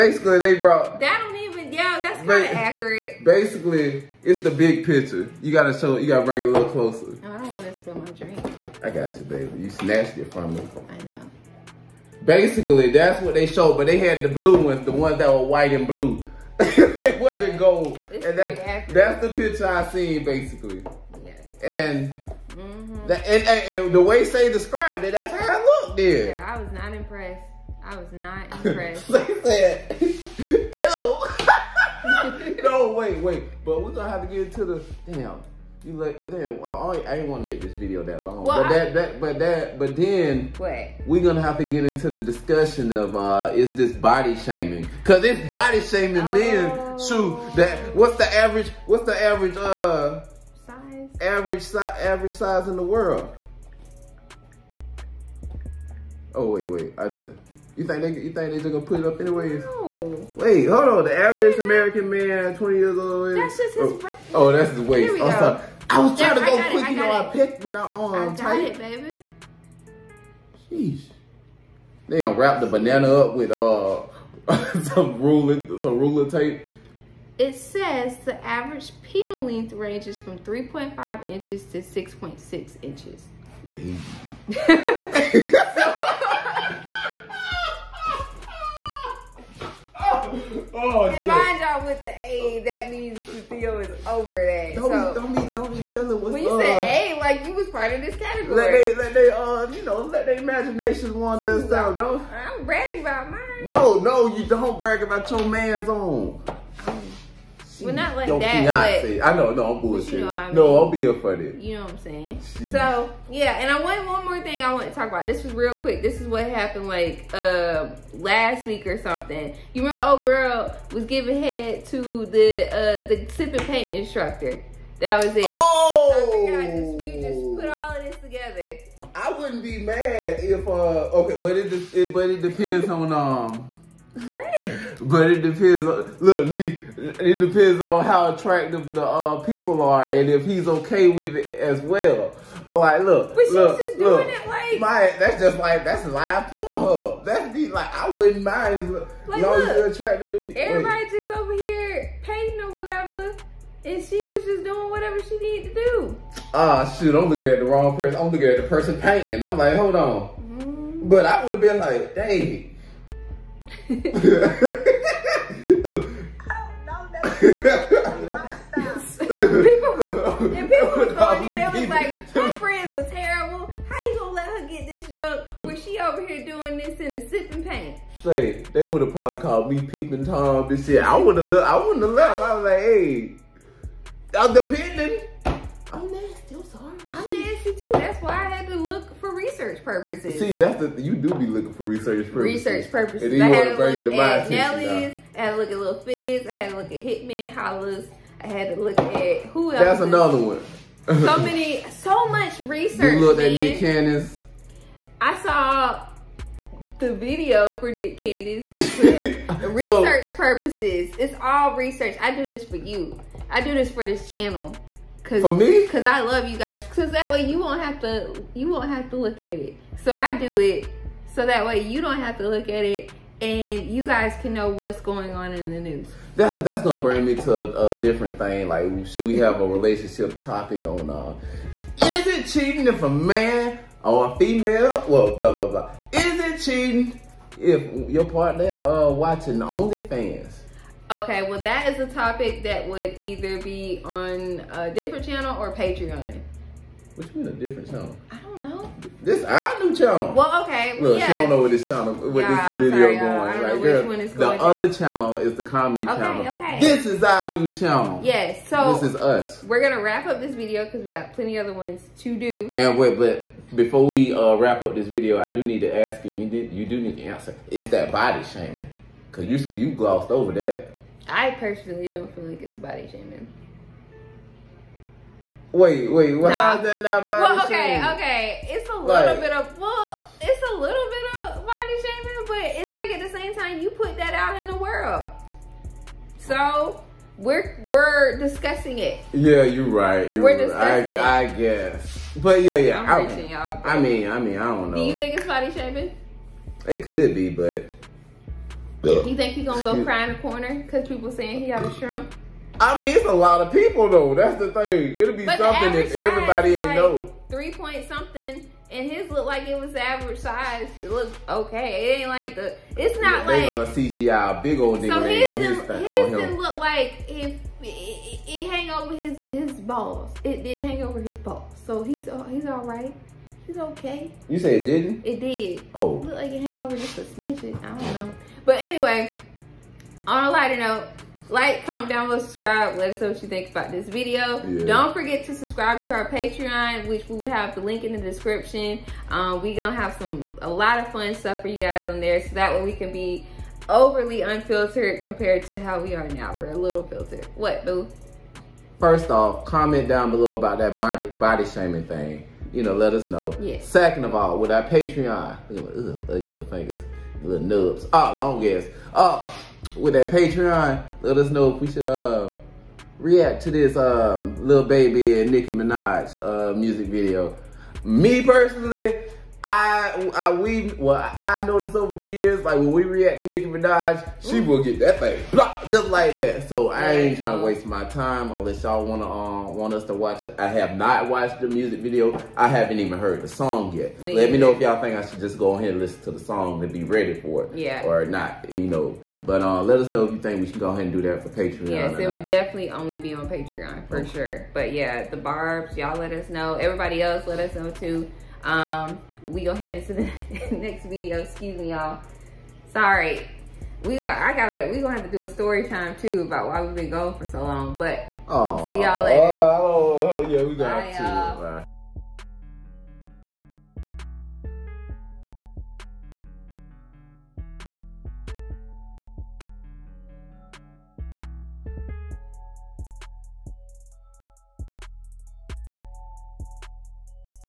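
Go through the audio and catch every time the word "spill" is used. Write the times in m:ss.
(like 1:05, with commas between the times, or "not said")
0:07.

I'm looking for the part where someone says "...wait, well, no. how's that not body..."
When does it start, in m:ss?
4:36.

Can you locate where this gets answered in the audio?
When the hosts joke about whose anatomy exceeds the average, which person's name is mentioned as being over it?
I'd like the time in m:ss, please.
1:33.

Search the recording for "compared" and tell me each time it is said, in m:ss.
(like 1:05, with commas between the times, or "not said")
5:45.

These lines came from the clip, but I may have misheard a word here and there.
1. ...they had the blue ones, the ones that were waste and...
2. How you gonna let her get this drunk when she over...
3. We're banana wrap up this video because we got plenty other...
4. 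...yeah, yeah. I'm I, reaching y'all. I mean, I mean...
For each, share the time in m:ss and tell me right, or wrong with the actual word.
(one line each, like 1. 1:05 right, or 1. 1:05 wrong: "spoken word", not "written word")
1. 0:13 wrong: "white", not "waste"
2. 2:53 right
3. 4:19 wrong: "gonna", not "banana"
4. 4:52 right.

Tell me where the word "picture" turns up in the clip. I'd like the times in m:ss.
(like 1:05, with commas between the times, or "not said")
0:04, 0:19.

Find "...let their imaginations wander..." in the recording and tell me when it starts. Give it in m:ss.
1:40.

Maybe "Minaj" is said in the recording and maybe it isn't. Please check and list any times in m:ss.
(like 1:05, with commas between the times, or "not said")
6:05, 6:13.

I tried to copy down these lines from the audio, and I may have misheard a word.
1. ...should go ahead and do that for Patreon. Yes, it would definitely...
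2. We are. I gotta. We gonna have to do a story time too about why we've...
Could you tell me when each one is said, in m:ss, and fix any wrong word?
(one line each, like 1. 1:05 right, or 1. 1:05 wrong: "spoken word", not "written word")
1. 6:30 right
2. 6:44 right.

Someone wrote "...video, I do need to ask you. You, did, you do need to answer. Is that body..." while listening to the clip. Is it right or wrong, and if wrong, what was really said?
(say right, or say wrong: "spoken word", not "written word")
right.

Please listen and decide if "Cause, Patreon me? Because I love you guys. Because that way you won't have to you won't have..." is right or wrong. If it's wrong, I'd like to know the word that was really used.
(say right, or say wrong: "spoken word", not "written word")
wrong: "For", not "Patreon".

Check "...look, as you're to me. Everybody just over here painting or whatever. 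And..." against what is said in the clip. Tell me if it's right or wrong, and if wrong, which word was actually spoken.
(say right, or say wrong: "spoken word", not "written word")
right.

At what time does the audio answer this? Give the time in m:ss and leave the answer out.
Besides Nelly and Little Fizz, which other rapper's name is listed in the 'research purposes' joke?
3:17.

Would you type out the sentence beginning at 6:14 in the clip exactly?
will get that thing, blah, just like that.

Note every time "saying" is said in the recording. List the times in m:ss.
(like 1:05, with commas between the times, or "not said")
1:51, 5:01.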